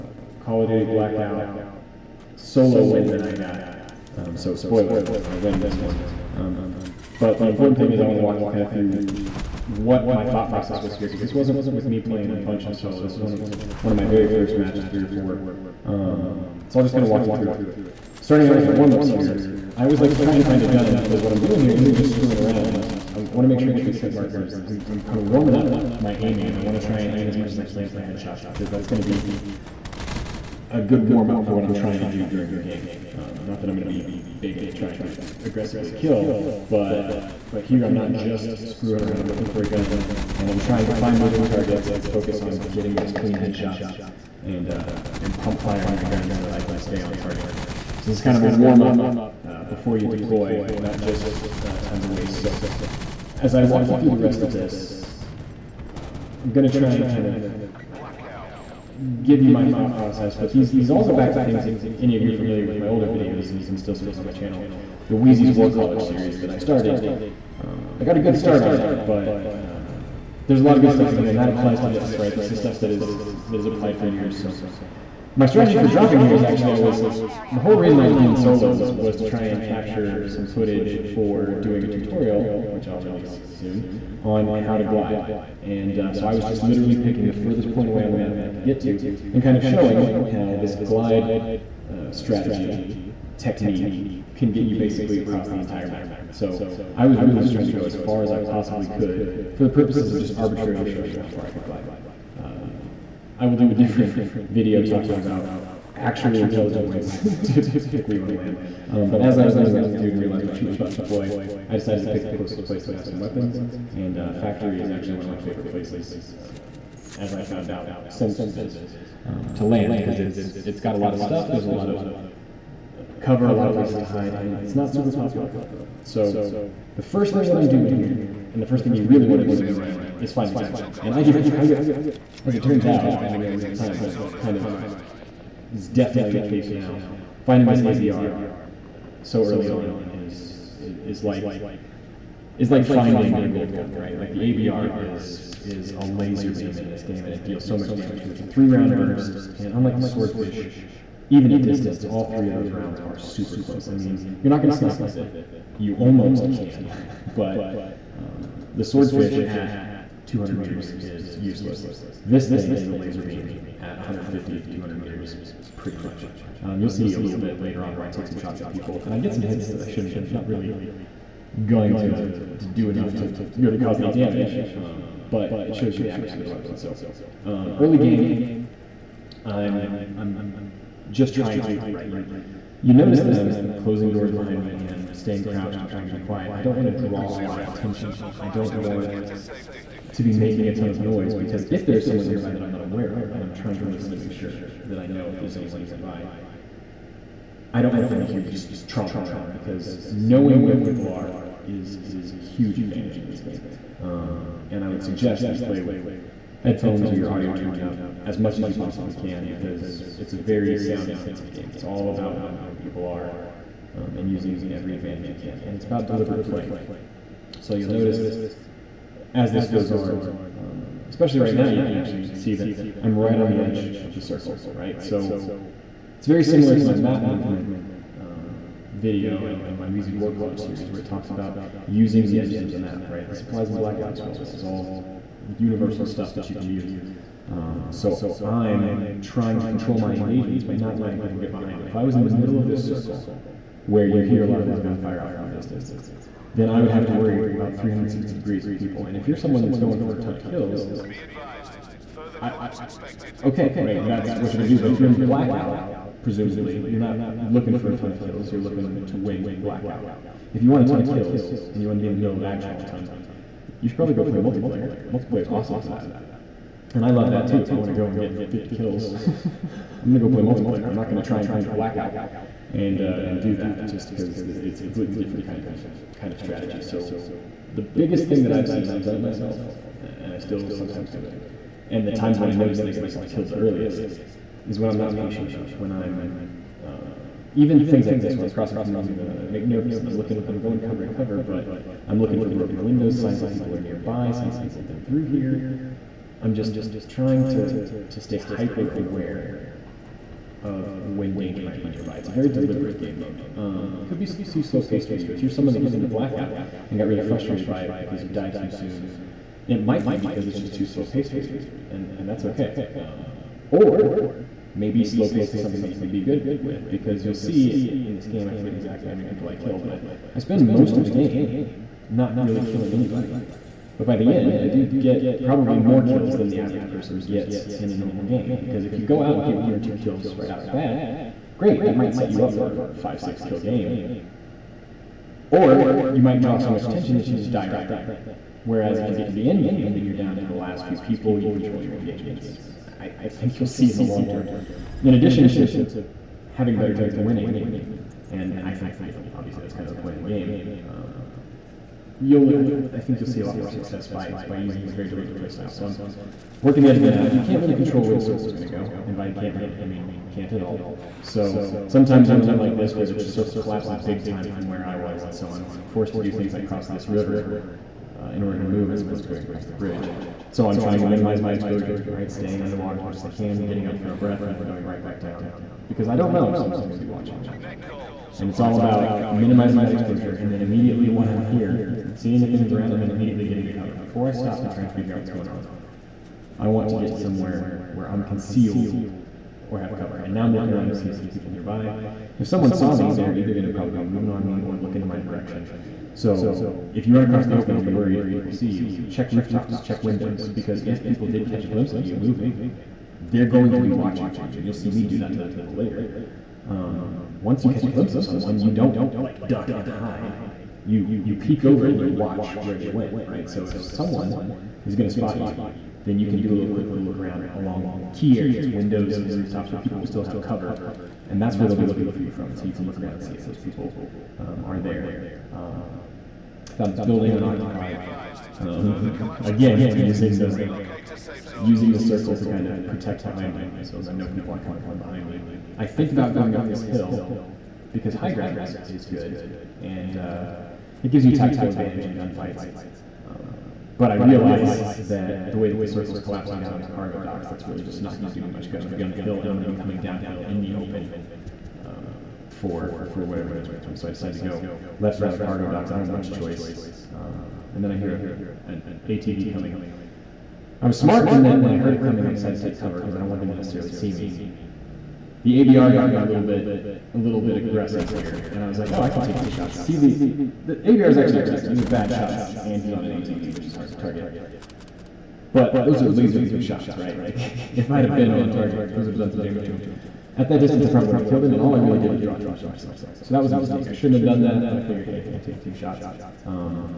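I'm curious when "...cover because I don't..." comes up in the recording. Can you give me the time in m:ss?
7:42.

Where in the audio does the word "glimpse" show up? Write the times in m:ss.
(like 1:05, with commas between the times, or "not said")
6:41, 6:47.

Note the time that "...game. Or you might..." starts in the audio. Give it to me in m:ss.
5:33.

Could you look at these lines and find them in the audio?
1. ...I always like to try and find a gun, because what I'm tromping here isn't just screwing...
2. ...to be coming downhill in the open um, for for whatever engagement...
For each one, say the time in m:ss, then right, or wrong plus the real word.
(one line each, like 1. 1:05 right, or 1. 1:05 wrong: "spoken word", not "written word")
1. 0:19 wrong: "doing", not "tromping"
2. 7:29 right.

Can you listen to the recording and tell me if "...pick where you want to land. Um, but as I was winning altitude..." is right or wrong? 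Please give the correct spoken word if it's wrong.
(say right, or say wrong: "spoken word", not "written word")
wrong: "losing", not "winning".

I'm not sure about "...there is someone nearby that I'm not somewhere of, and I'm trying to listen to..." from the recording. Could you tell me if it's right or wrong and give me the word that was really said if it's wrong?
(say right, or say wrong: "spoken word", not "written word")
wrong: "aware", not "somewhere".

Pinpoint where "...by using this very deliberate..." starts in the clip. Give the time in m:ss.
5:54.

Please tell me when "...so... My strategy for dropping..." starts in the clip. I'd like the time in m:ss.
1:14.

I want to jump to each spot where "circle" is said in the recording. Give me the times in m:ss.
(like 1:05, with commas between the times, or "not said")
3:44, 4:02, 5:58, 6:03, 7:11, 7:25.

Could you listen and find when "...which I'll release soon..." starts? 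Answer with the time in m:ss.
1:22.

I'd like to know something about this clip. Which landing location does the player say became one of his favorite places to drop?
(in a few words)
Factory.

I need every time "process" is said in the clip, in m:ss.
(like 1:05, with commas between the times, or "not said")
0:10, 0:59.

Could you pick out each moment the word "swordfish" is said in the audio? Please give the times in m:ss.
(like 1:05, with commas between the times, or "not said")
2:30, 2:38.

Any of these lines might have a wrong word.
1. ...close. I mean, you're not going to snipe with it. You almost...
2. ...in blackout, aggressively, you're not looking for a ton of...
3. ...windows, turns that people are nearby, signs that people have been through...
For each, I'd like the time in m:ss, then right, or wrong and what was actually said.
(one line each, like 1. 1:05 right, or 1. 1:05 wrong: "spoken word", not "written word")
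1. 2:33 right
2. 4:15 wrong: "presumably", not "aggressively"
3. 4:52 wrong: "signs", not "turns".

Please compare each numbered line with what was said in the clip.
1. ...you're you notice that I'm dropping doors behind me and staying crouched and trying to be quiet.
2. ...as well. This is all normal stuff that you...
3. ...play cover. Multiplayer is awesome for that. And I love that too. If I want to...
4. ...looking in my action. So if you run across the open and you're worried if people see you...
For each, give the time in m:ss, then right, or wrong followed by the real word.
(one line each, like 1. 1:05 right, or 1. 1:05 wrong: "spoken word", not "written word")
1. 3:02 wrong: "closing", not "dropping"
2. 3:54 wrong: "universal", not "normal"
3. 4:24 wrong: "multiplayer", not "cover"
4. 6:34 wrong: "direction", not "action".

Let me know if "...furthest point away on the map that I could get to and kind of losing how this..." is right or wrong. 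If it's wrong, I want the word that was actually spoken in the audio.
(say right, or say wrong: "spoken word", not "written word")
wrong: "showing", not "losing".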